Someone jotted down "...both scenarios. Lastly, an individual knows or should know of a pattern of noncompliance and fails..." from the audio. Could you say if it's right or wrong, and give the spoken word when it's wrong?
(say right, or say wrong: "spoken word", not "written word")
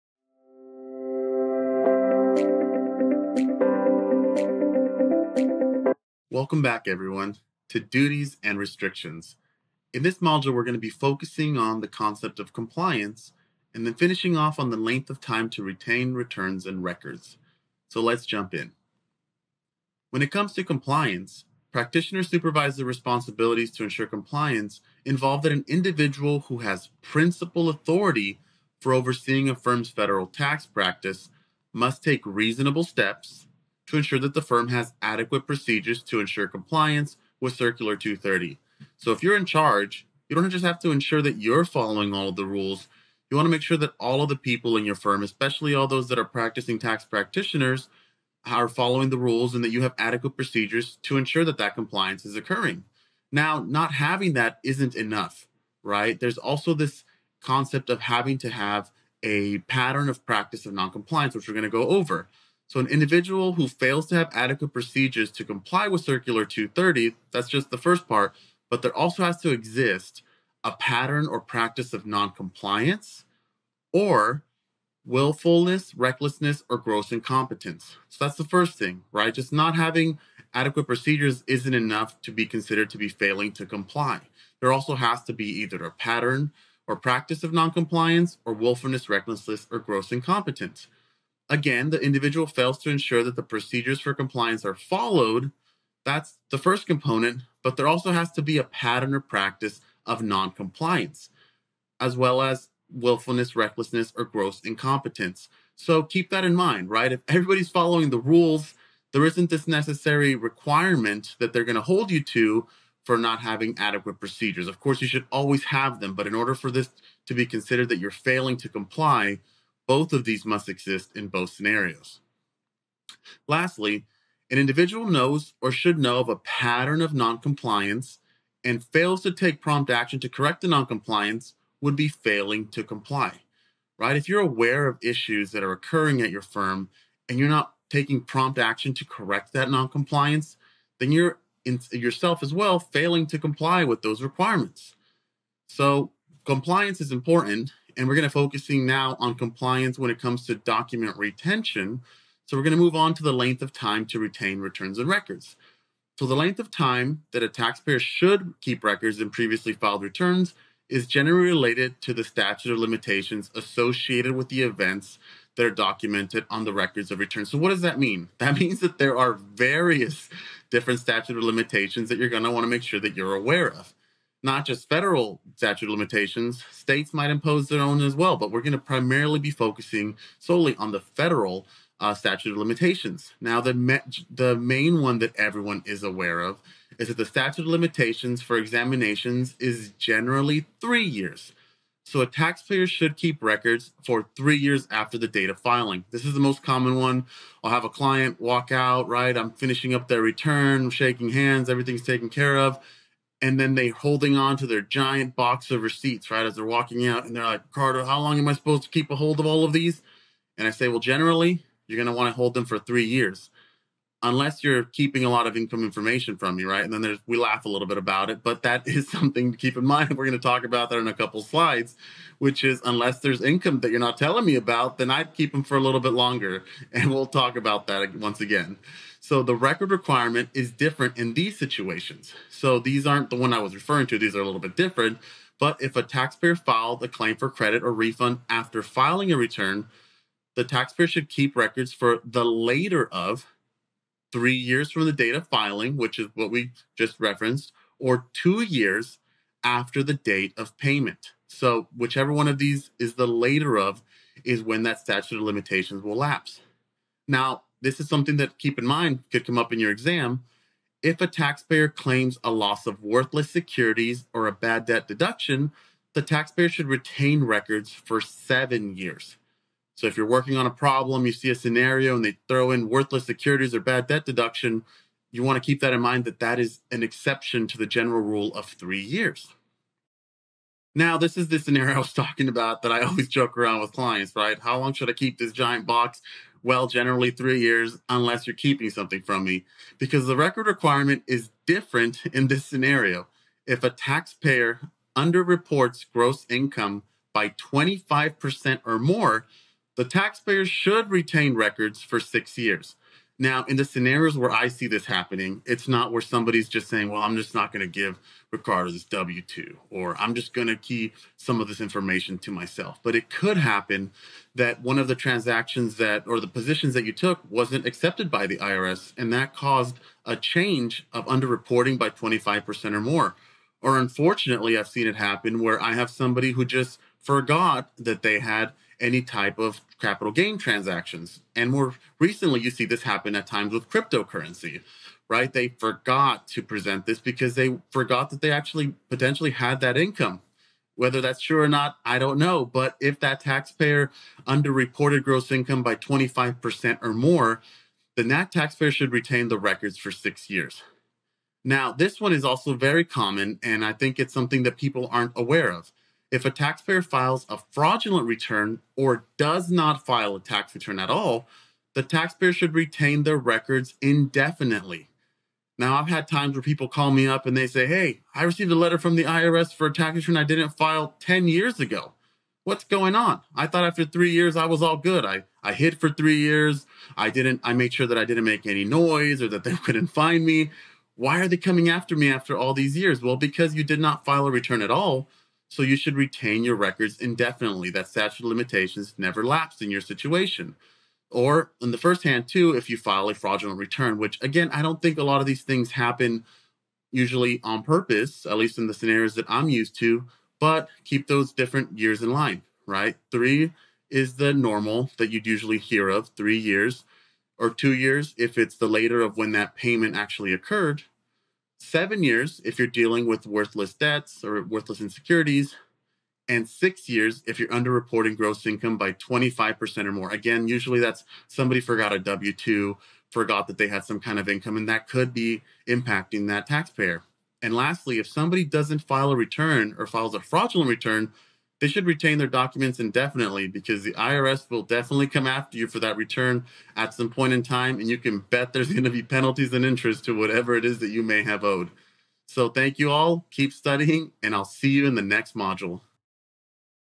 right.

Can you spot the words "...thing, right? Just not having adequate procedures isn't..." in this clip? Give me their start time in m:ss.
1:18.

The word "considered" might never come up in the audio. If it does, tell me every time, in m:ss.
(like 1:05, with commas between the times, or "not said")
1:22, 1:57.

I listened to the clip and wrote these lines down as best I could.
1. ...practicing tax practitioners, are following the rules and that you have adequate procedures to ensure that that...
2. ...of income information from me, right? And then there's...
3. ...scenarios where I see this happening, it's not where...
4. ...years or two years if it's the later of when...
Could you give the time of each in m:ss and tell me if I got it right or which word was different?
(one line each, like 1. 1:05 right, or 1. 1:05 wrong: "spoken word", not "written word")
1. 0:46 right
2. 3:35 right
3. 5:03 right
4. 6:46 right.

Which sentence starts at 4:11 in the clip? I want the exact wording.
So, whichever one of these is the later of is when that statute of limitations will lapse.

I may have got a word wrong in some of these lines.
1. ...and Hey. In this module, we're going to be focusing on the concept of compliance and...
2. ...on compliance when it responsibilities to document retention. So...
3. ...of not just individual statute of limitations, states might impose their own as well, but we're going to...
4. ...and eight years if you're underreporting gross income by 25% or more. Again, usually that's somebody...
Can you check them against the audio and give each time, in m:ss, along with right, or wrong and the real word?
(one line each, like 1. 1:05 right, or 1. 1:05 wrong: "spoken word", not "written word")
1. 0:08 wrong: "Restrictions", not "Hey"
2. 2:29 wrong: "comes", not "responsibilities"
3. 2:53 wrong: "federal", not "individual"
4. 6:56 wrong: "six", not "eight".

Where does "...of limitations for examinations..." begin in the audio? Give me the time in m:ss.
3:07.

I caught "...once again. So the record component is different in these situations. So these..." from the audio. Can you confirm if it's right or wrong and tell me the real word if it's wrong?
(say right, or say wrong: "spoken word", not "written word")
wrong: "requirement", not "component".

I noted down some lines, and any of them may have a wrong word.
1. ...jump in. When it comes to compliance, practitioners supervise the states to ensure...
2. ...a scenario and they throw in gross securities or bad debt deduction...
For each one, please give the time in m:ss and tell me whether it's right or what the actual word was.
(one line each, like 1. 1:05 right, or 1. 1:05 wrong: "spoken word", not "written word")
1. 0:18 wrong: "responsibilities", not "states"
2. 4:31 wrong: "worthless", not "gross".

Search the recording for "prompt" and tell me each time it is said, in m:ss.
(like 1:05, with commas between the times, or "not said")
2:09, 2:18.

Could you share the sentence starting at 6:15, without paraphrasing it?
I, I hid for three years.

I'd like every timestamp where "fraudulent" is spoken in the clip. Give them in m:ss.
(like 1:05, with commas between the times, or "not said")
5:57, 6:33, 7:10.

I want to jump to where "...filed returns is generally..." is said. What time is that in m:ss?
2:39.